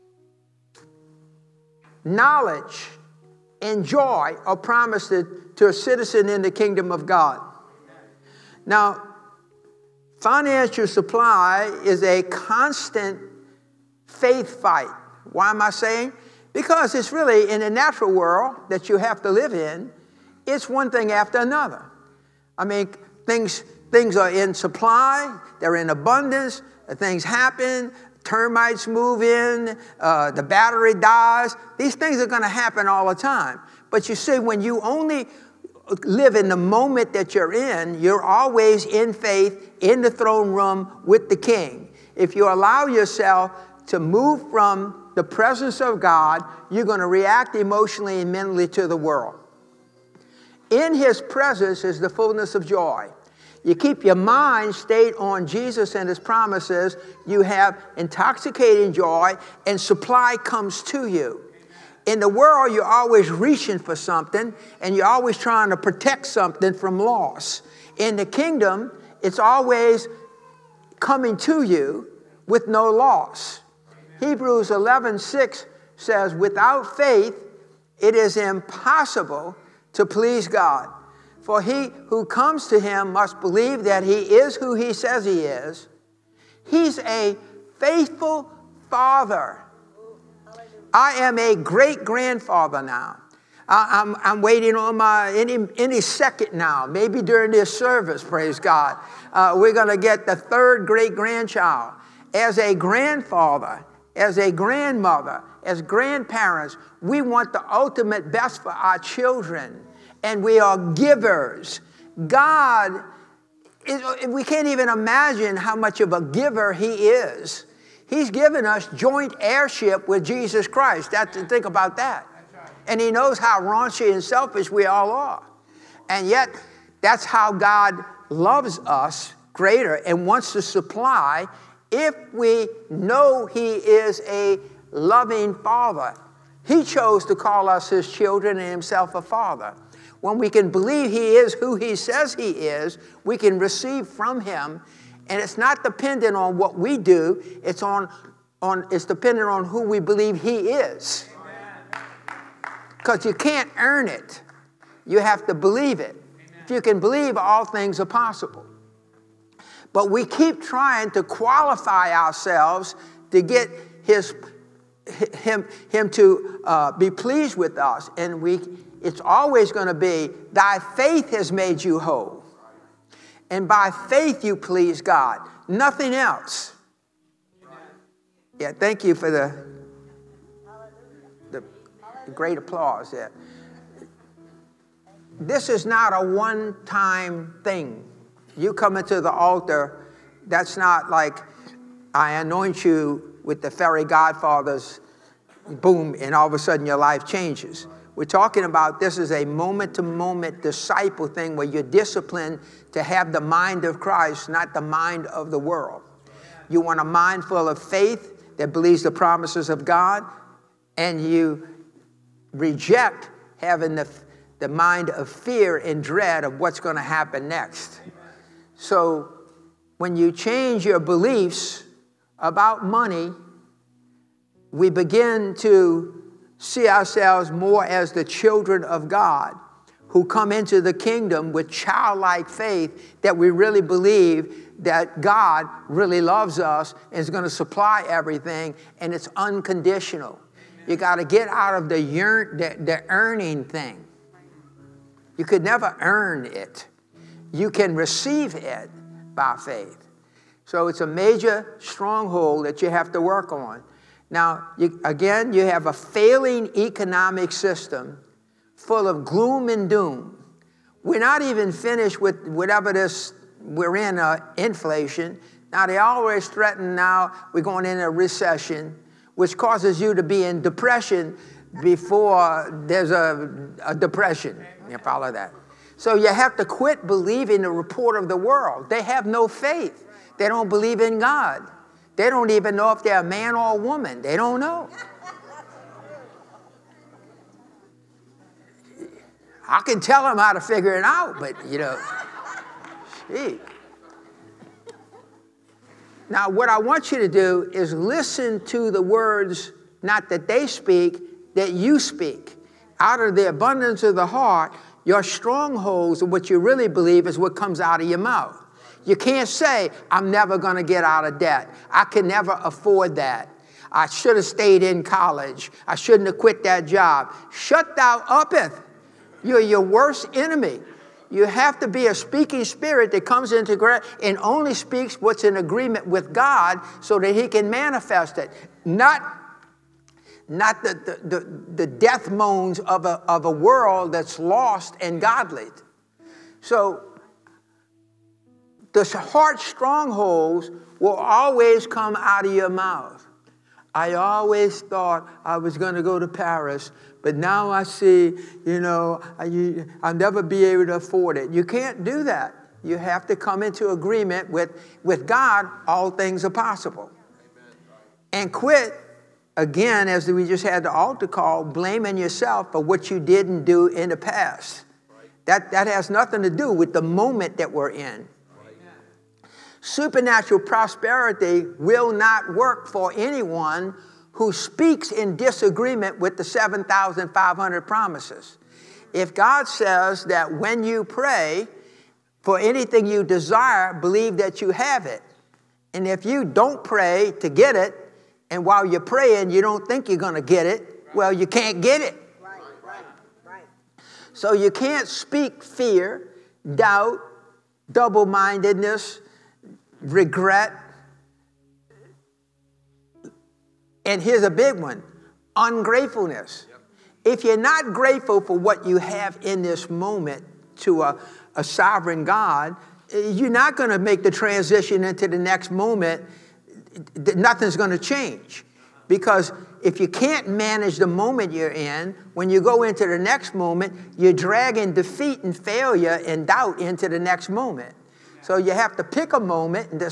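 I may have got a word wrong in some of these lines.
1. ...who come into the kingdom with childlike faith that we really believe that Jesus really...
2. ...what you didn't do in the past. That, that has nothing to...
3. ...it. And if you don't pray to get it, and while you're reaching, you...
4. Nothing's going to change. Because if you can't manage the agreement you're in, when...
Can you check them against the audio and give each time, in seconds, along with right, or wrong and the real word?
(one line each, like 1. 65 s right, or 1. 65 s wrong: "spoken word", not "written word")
1. 230 s wrong: "God", not "Jesus"
2. 362 s right
3. 385 s wrong: "praying", not "reaching"
4. 417 s wrong: "moment", not "agreement".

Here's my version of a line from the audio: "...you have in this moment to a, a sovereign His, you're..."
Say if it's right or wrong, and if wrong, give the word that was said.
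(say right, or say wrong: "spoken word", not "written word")
wrong: "God", not "His".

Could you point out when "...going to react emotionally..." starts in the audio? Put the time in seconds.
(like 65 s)
46 s.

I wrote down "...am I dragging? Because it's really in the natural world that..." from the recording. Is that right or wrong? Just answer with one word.
wrong.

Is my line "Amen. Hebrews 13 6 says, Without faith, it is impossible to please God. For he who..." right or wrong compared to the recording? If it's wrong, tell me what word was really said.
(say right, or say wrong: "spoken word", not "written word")
wrong: "11", not "13".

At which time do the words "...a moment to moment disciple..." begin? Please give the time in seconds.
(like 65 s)
199 s.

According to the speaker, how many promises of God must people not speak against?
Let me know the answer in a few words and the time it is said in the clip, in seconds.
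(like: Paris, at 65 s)
7,500, at 376 s.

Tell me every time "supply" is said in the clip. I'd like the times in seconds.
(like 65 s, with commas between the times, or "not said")
10 s, 24 s, 59 s, 130 s, 237 s.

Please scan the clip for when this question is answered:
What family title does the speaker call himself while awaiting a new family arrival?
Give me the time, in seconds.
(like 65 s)
91 s.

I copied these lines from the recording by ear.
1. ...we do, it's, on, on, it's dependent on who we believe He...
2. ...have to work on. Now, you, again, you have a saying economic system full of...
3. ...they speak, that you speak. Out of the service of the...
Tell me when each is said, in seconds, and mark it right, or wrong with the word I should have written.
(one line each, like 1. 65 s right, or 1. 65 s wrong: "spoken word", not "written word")
1. 146 s right
2. 252 s wrong: "failing", not "saying"
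3. 300 s wrong: "abundance", not "service".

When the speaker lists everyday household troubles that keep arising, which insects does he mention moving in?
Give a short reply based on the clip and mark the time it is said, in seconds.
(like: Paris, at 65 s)
Termites, at 28 s.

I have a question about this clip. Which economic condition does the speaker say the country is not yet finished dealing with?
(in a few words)
Inflation.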